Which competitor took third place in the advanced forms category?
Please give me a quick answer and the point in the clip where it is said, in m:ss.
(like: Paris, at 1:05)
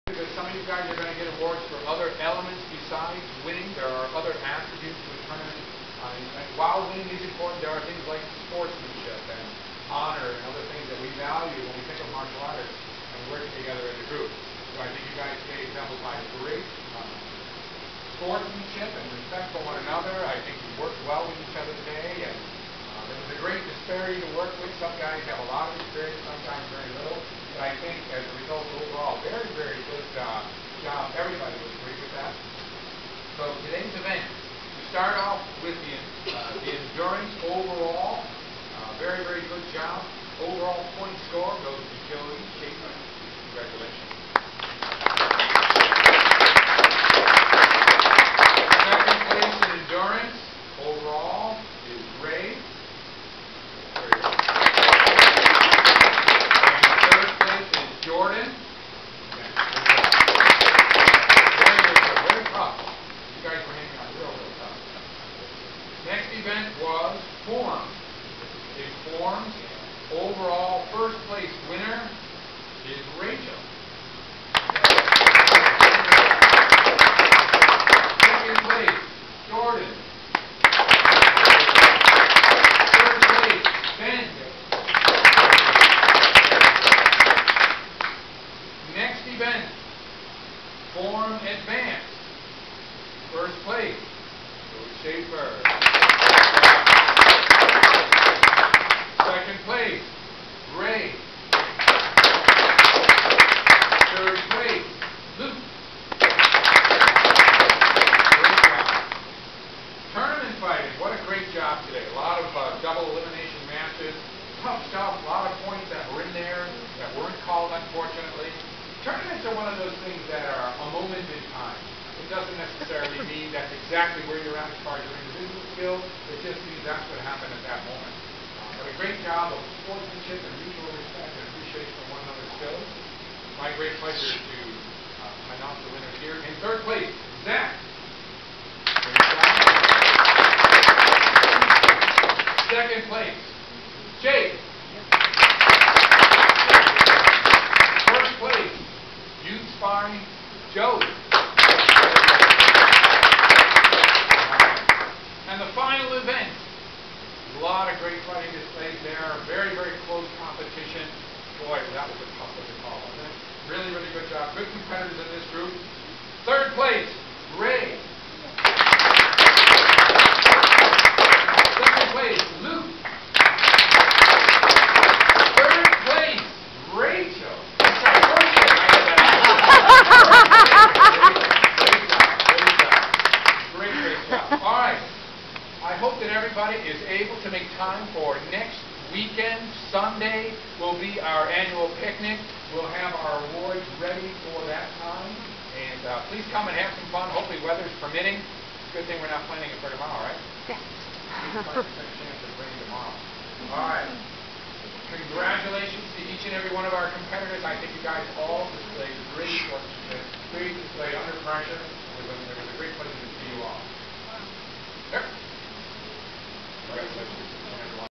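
Luke, at 1:45.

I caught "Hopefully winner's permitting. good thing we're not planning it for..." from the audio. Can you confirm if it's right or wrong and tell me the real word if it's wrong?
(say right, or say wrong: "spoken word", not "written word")
wrong: "weather", not "winner".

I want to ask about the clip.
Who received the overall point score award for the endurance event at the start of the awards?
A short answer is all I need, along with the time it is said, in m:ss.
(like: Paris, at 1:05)
Joey Chapin, at 0:42.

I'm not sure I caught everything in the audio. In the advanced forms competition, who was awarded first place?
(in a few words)
George Schaefer.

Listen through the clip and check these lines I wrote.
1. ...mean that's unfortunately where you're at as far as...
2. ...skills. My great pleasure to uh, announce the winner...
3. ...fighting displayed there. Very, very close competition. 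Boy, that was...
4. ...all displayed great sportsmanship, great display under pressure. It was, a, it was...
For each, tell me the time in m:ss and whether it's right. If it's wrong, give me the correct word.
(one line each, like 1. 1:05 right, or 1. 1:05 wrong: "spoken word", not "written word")
1. 2:03 wrong: "exactly", not "unfortunately"
2. 2:12 right
3. 2:38 right
4. 3:28 right.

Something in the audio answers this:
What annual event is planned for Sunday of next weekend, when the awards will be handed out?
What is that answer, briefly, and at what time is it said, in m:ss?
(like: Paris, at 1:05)
Picnic, at 3:12.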